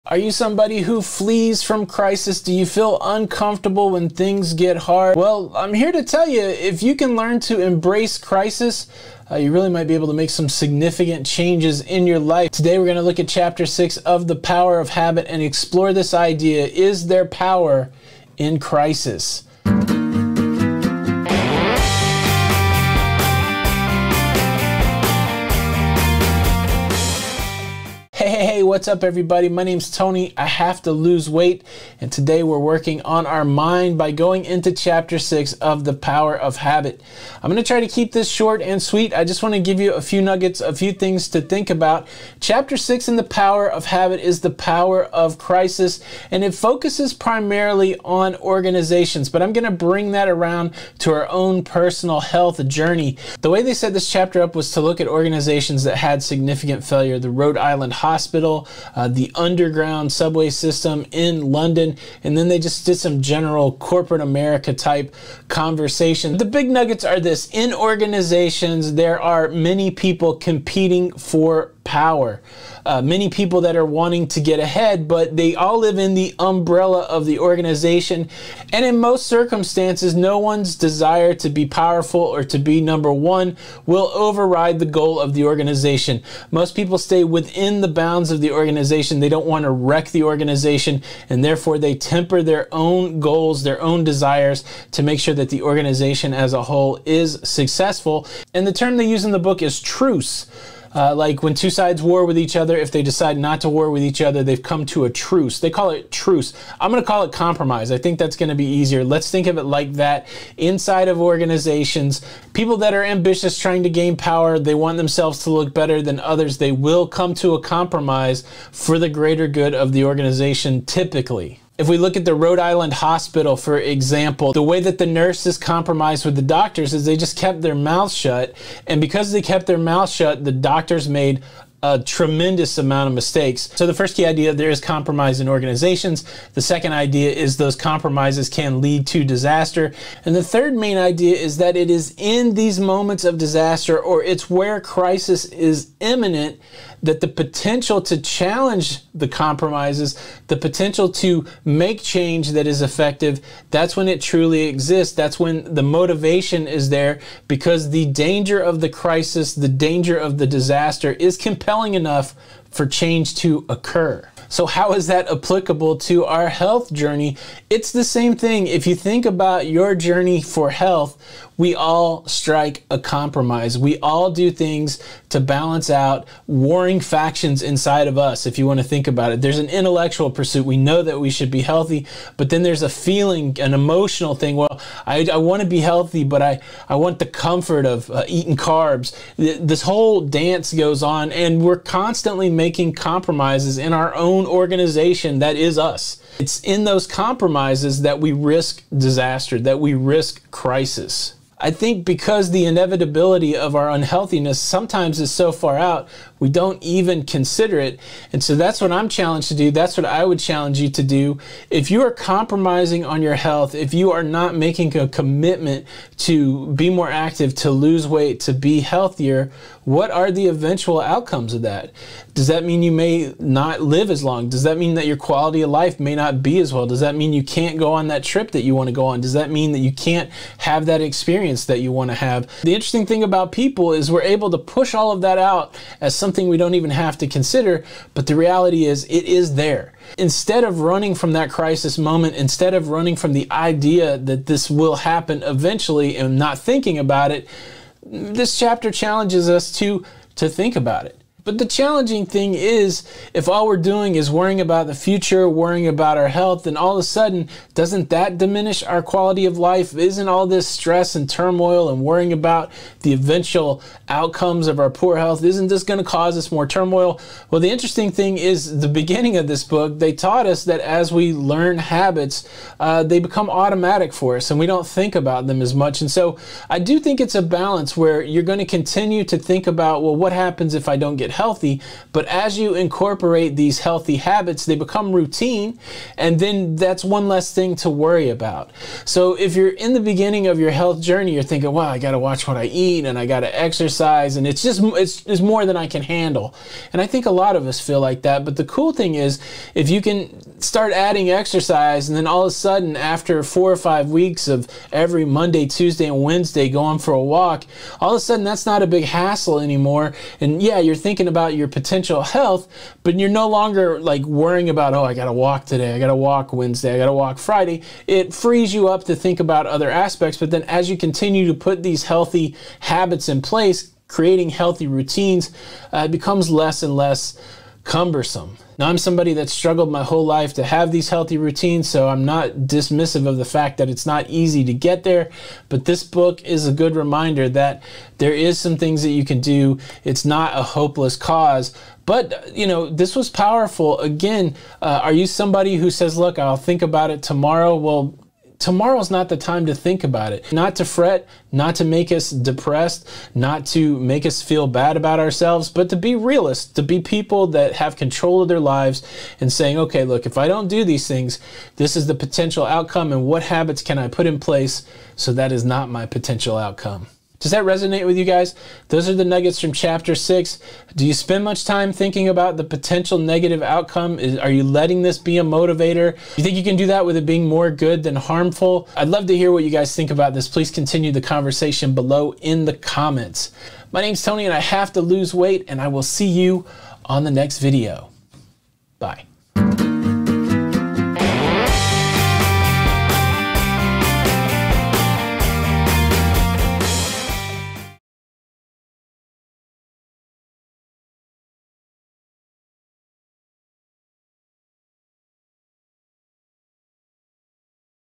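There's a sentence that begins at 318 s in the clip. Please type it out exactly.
It frees you up to think about other aspects.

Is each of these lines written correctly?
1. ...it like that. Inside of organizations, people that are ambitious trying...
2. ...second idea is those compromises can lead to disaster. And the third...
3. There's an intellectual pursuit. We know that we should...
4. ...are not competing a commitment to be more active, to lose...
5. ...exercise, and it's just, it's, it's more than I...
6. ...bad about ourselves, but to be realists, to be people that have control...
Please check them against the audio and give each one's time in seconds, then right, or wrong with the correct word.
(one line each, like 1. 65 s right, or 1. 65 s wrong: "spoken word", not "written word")
1. 109 s right
2. 136 s right
3. 179 s right
4. 214 s wrong: "making", not "competing"
5. 293 s right
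6. 354 s right.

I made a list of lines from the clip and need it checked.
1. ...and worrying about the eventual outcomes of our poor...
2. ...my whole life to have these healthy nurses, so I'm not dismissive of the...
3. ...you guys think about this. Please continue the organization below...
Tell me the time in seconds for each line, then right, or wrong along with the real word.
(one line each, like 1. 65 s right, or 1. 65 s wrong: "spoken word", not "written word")
1. 261 s right
2. 329 s wrong: "routines", not "nurses"
3. 379 s wrong: "conversation", not "organization".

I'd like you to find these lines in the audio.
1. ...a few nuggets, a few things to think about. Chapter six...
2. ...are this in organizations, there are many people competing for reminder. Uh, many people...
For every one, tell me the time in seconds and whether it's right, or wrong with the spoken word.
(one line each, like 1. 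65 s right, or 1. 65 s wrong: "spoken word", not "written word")
1. 39 s right
2. 67 s wrong: "power", not "reminder".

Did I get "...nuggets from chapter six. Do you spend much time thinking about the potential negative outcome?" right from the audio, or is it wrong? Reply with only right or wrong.
right.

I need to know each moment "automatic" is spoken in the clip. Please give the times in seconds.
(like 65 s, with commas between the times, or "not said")
273 s.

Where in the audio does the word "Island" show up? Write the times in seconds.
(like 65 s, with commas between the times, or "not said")
57 s, 122 s.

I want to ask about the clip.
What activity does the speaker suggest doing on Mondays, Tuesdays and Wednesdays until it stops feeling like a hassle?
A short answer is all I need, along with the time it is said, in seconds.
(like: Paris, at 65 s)
Going for a walk, at 306 s.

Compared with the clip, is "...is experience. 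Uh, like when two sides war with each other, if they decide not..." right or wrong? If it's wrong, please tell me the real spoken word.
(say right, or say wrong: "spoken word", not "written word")
wrong: "truce", not "experience".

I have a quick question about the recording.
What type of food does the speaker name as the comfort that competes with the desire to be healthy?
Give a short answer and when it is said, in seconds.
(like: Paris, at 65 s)
Carbs, at 188 s.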